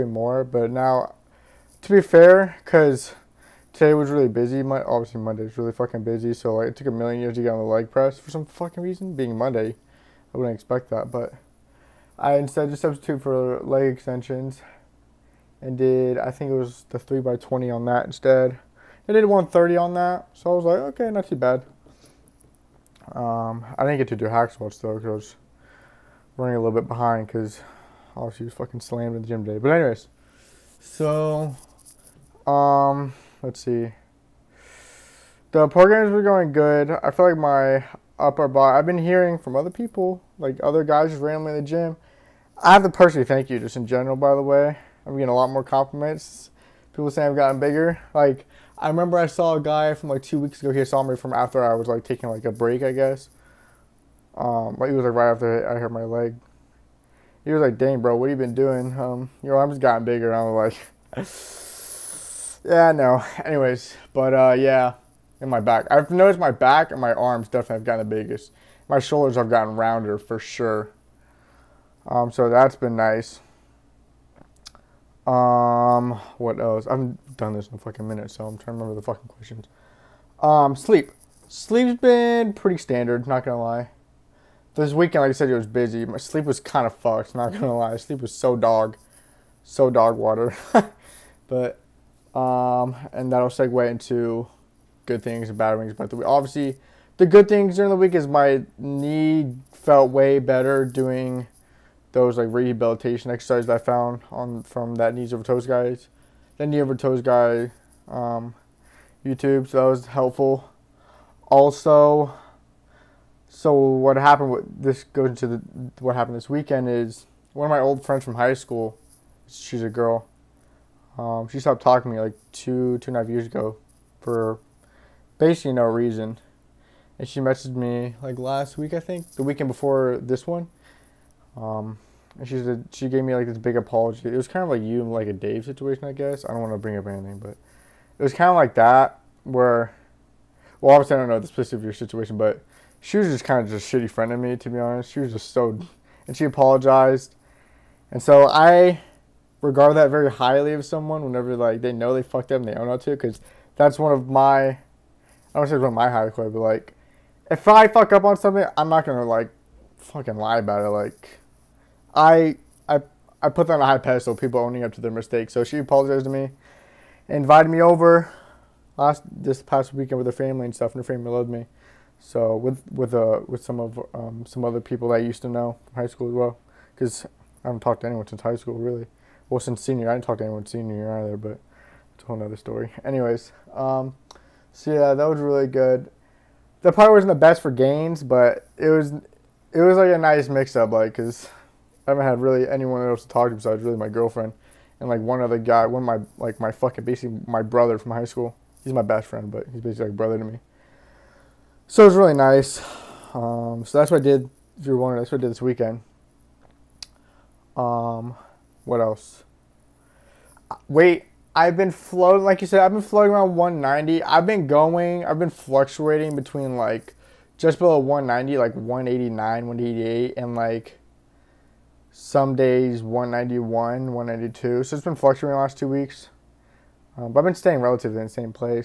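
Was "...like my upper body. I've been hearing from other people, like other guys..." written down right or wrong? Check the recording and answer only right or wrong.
right.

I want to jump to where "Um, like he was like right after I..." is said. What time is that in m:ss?
0:54.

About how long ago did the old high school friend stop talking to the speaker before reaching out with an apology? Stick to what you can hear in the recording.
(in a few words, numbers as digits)
2.5 years.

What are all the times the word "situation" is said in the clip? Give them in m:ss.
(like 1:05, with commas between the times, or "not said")
2:15, 2:21.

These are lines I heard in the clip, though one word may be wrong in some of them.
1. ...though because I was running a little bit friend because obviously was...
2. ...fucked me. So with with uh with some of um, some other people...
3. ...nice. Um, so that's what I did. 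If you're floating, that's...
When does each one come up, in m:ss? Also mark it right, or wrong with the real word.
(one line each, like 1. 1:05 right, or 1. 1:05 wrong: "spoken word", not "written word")
1. 0:24 wrong: "behind", not "friend"
2. 2:51 wrong: "loved", not "fucked"
3. 3:22 wrong: "wondering", not "floating".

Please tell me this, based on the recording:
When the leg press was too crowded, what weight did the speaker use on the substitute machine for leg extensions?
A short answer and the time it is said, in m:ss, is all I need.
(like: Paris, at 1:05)
130, at 0:19.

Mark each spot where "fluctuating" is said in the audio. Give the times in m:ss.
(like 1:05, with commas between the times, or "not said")
3:35, 3:45.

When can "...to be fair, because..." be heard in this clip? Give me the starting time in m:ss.
0:01.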